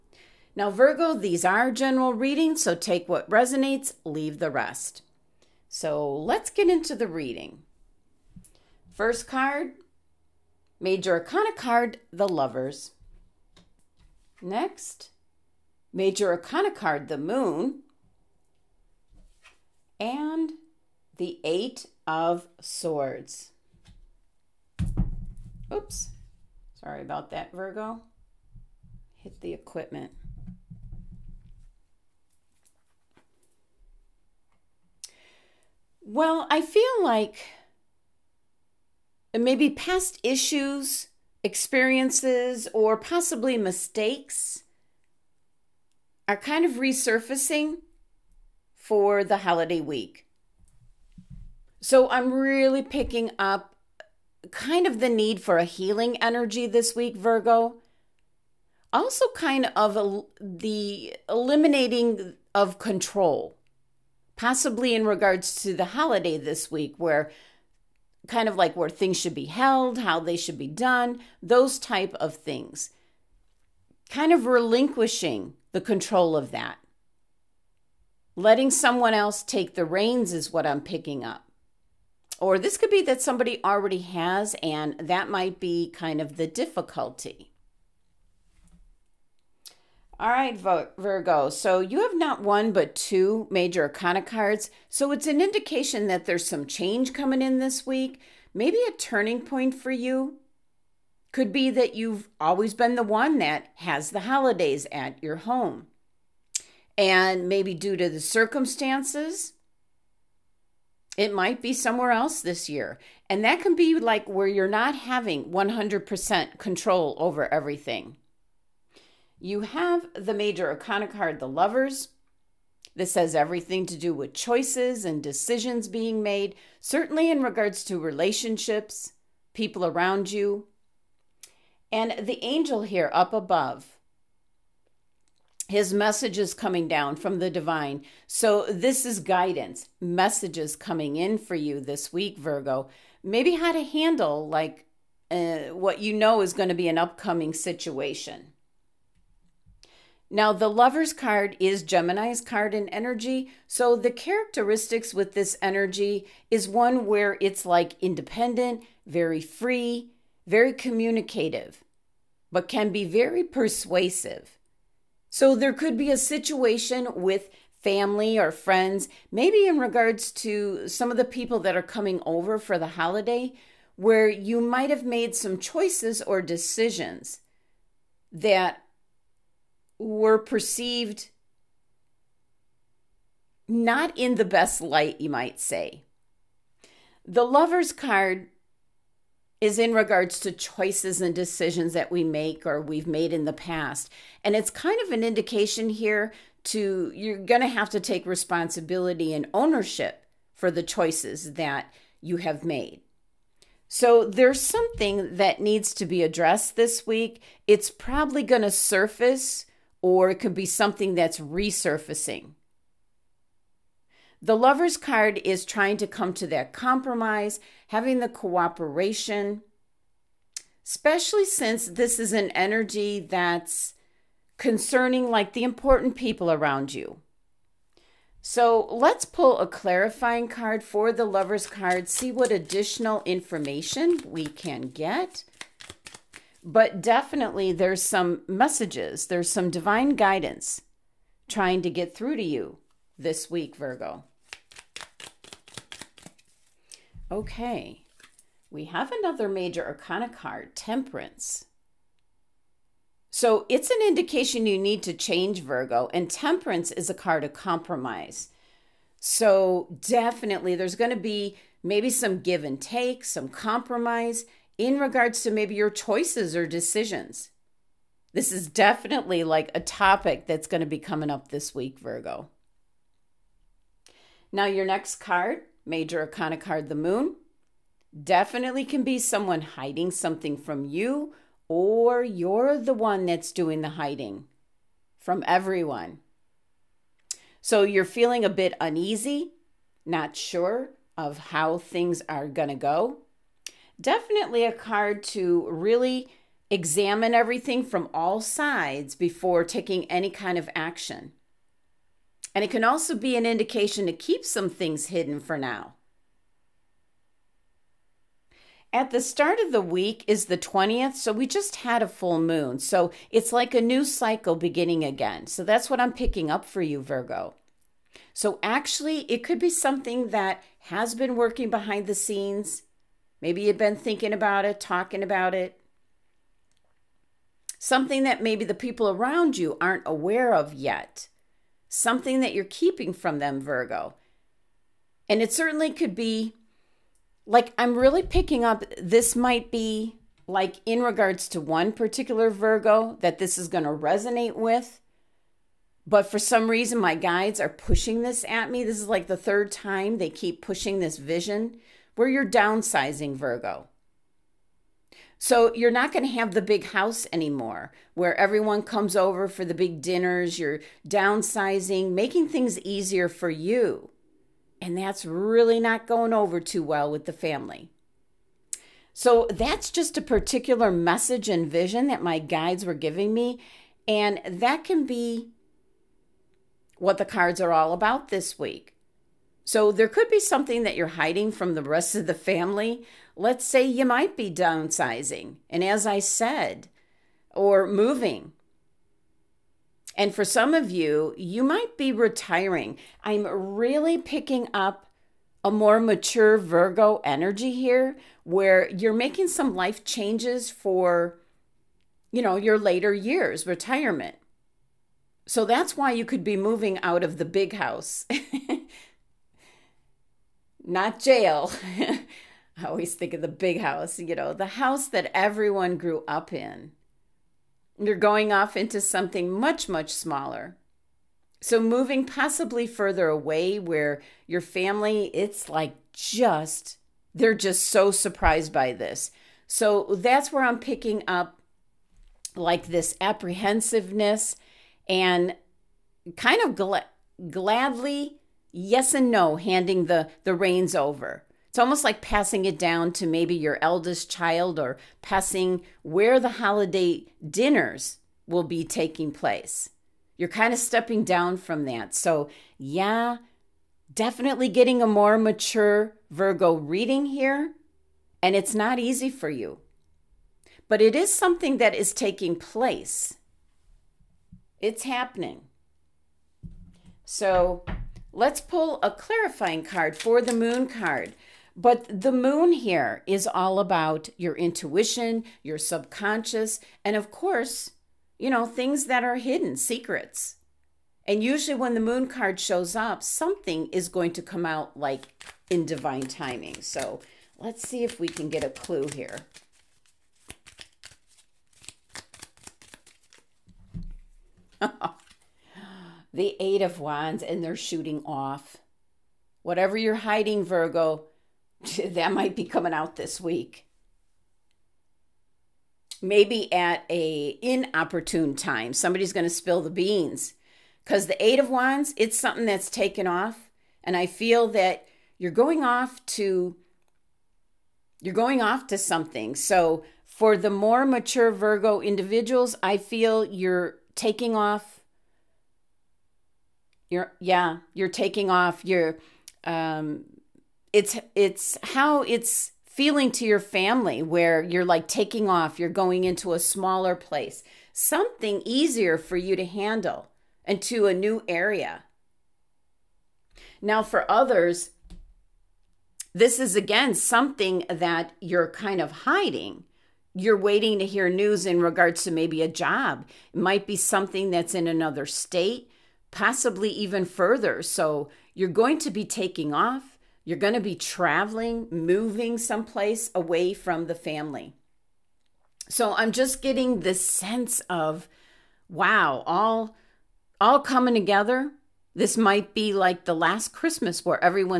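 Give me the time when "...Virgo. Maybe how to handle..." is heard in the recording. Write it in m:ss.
2:22.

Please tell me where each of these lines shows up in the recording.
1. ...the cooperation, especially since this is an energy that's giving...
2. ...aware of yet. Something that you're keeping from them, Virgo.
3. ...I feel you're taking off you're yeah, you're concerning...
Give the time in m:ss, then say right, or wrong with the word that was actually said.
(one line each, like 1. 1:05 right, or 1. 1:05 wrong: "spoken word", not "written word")
1. 3:38 wrong: "concerning", not "giving"
2. 5:30 right
3. 8:42 wrong: "taking", not "concerning".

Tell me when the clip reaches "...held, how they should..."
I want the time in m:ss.
1:09.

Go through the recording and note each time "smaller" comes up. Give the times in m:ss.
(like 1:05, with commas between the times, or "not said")
7:00, 8:56.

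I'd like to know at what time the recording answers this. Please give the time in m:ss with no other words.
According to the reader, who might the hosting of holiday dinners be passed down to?
7:23.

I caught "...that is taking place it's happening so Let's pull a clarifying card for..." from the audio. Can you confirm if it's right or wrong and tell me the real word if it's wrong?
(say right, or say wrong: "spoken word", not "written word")
right.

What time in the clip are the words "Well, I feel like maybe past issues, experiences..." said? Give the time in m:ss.
0:36.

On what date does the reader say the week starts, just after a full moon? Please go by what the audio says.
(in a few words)
20th.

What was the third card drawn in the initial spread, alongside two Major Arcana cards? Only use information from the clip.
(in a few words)
Eight of Swords.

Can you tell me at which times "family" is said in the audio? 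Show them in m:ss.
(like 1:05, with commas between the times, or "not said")
2:47, 6:07, 6:22, 7:04, 8:53, 9:24.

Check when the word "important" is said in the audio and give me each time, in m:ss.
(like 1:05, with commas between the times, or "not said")
3:45.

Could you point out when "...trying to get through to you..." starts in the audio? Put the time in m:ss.
4:01.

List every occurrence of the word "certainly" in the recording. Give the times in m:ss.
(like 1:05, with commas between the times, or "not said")
2:06, 5:35.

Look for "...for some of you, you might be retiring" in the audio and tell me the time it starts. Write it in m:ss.
6:30.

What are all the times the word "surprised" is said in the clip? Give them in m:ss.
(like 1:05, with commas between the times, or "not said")
7:08.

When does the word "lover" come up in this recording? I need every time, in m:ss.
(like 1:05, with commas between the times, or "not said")
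0:12, 2:01, 2:30, 3:07, 3:34, 3:51.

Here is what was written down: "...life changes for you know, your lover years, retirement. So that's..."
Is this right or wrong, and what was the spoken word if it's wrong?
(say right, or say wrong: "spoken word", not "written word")
wrong: "later", not "lover".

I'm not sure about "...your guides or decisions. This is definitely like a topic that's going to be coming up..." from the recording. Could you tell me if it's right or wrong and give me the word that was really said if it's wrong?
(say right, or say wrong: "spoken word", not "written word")
wrong: "choices", not "guides".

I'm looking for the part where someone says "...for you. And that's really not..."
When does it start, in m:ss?
6:03.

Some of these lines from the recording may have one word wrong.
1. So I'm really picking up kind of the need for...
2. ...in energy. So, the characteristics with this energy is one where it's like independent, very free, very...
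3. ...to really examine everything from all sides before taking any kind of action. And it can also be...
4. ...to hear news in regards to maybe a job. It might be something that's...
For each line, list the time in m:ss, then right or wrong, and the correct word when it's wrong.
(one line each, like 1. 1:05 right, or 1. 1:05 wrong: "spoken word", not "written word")
1. 0:51 right
2. 2:32 right
3. 4:55 right
4. 9:10 right.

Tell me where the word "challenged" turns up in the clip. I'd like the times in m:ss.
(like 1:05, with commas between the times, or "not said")
not said.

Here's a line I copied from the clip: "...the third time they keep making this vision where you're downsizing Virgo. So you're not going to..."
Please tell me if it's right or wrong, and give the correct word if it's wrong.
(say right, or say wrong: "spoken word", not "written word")
wrong: "pushing", not "making".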